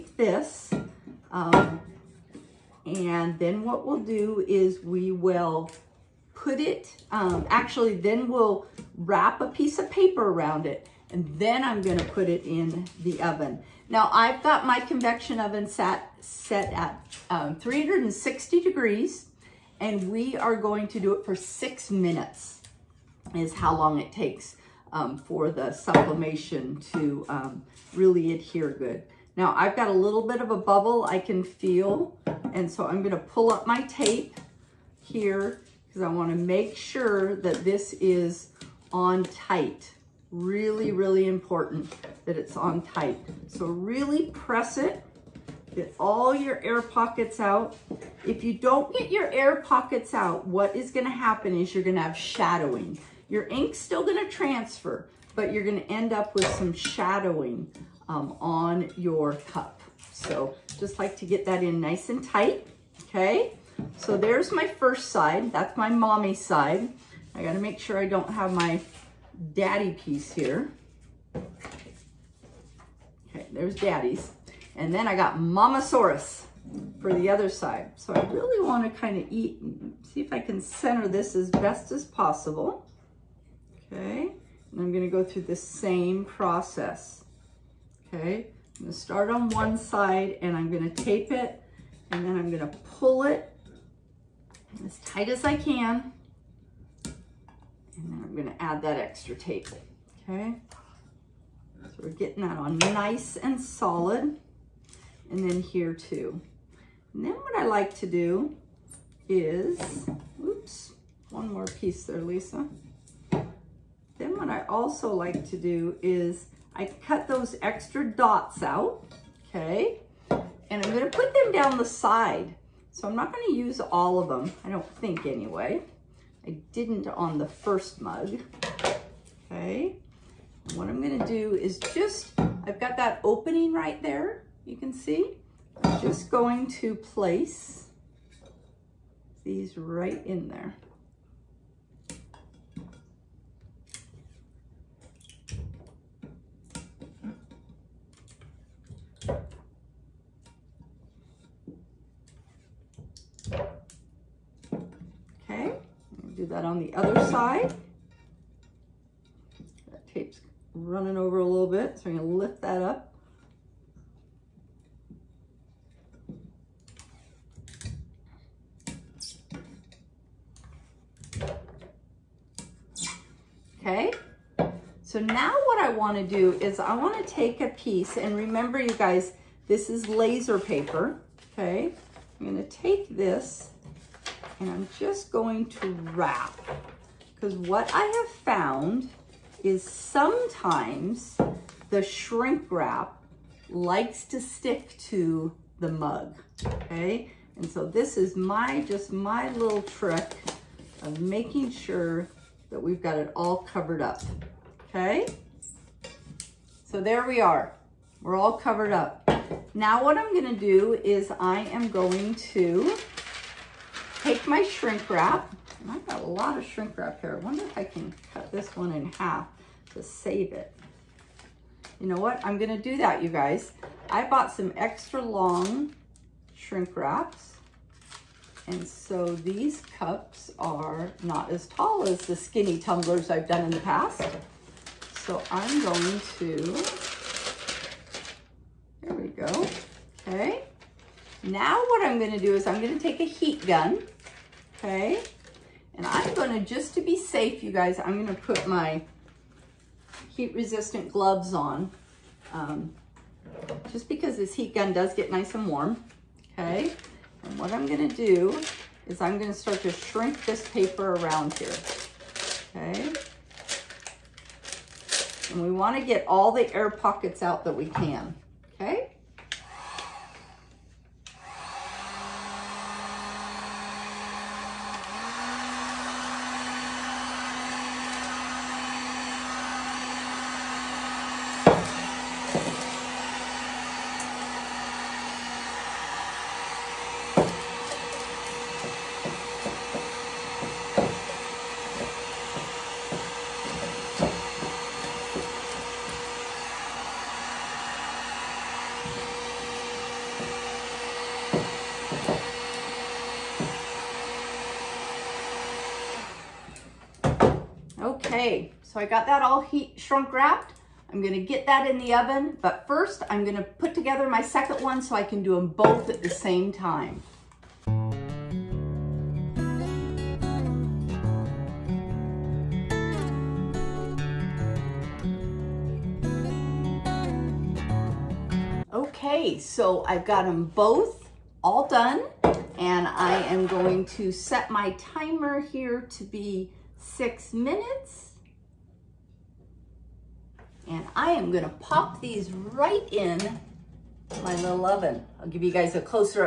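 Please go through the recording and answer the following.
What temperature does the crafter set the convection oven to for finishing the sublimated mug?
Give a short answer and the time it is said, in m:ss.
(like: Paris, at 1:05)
360 degrees, at 0:17.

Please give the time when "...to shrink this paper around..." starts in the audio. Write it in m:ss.
4:19.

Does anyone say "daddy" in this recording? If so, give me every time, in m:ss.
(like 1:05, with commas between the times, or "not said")
1:09, 1:13.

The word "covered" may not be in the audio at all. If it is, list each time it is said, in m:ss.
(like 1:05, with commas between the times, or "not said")
3:23, 3:28.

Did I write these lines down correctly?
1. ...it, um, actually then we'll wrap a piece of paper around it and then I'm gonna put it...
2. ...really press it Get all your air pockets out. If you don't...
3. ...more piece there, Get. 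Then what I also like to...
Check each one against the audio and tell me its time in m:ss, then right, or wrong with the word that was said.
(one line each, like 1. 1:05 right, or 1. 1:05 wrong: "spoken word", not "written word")
1. 0:06 right
2. 0:43 right
3. 1:51 wrong: "Lisa", not "Get".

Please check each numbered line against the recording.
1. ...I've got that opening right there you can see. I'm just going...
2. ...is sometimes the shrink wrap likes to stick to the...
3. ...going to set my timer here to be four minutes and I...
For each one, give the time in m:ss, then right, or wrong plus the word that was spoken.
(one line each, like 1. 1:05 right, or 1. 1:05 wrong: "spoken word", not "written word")
1. 2:12 right
2. 3:09 right
3. 5:33 wrong: "six", not "four".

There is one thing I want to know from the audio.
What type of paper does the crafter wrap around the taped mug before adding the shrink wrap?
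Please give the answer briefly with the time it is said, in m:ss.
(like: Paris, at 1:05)
laser paper, at 3:00.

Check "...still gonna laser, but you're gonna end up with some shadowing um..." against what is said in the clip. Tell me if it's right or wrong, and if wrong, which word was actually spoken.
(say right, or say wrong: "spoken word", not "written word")
wrong: "transfer", not "laser".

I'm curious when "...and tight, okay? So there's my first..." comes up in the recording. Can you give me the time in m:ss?
1:02.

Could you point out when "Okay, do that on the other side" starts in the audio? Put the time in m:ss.
2:35.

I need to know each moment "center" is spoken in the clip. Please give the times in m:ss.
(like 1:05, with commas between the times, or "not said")
1:20.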